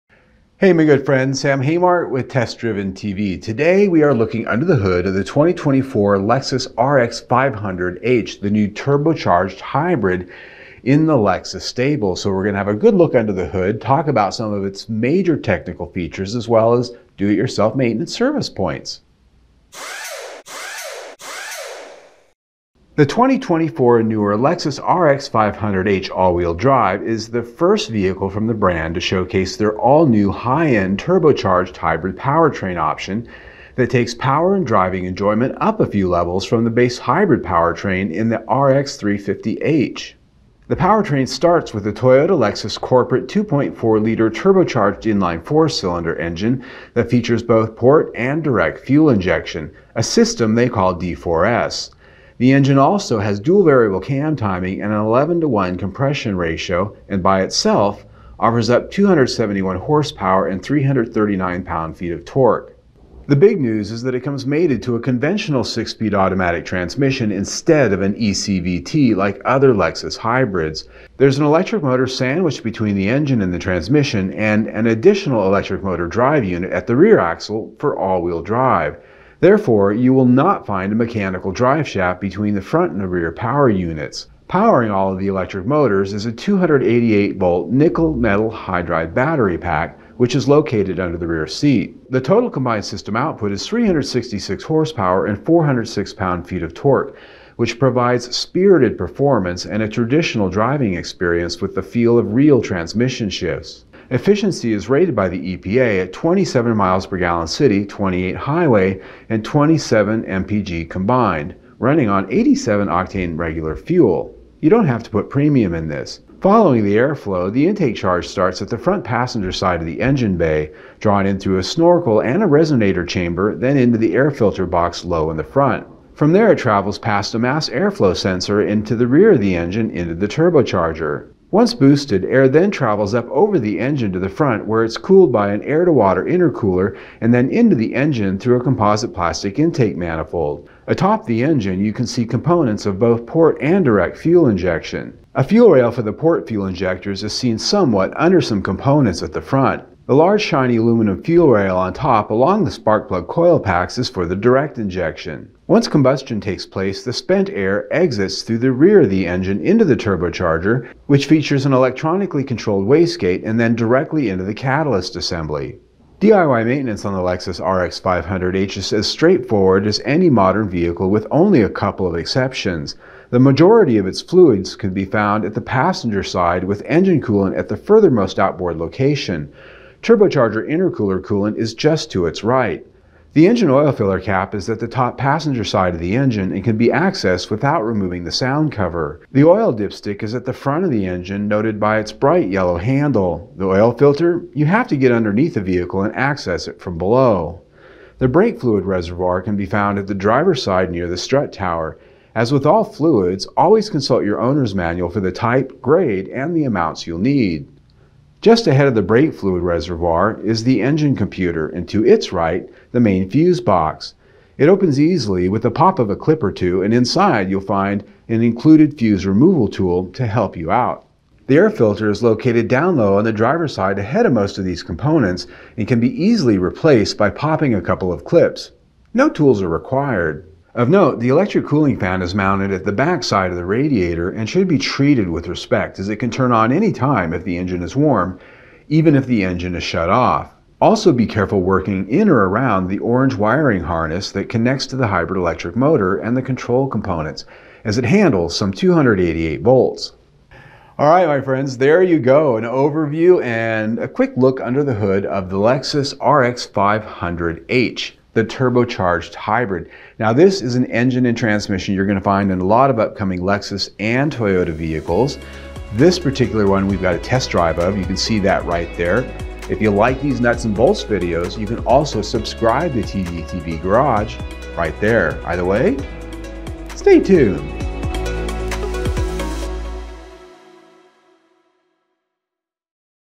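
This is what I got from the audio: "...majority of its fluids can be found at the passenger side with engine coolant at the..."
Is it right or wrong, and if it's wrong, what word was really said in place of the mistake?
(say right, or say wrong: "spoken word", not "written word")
right.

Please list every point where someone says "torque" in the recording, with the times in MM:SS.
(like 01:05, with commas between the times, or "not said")
01:02, 01:36.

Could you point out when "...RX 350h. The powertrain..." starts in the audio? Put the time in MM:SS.
00:38.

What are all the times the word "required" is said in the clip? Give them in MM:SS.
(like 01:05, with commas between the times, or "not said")
03:49.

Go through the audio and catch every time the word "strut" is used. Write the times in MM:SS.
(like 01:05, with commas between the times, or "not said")
03:21.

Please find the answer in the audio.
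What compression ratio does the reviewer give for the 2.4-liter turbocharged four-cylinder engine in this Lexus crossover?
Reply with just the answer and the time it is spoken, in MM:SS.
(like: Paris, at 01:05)
11 to 1, at 00:54.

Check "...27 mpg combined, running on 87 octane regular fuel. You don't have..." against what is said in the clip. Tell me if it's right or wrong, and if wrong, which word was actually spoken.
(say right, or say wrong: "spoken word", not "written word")
right.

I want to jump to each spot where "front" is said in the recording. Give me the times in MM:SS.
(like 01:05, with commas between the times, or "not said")
01:22, 01:58, 02:05, 02:14, 02:29, 03:10.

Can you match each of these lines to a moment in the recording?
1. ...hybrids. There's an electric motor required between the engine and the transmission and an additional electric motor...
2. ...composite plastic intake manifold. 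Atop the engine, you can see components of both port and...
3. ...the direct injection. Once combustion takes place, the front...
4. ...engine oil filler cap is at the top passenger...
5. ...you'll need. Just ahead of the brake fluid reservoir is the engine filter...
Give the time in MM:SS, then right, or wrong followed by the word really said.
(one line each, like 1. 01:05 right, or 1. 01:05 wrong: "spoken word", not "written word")
1. 01:10 wrong: "sandwiched", not "required"
2. 02:18 right
3. 02:34 wrong: "spent", not "front"
4. 03:03 right
5. 03:27 wrong: "computer", not "filter".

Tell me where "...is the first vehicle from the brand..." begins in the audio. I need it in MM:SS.
00:27.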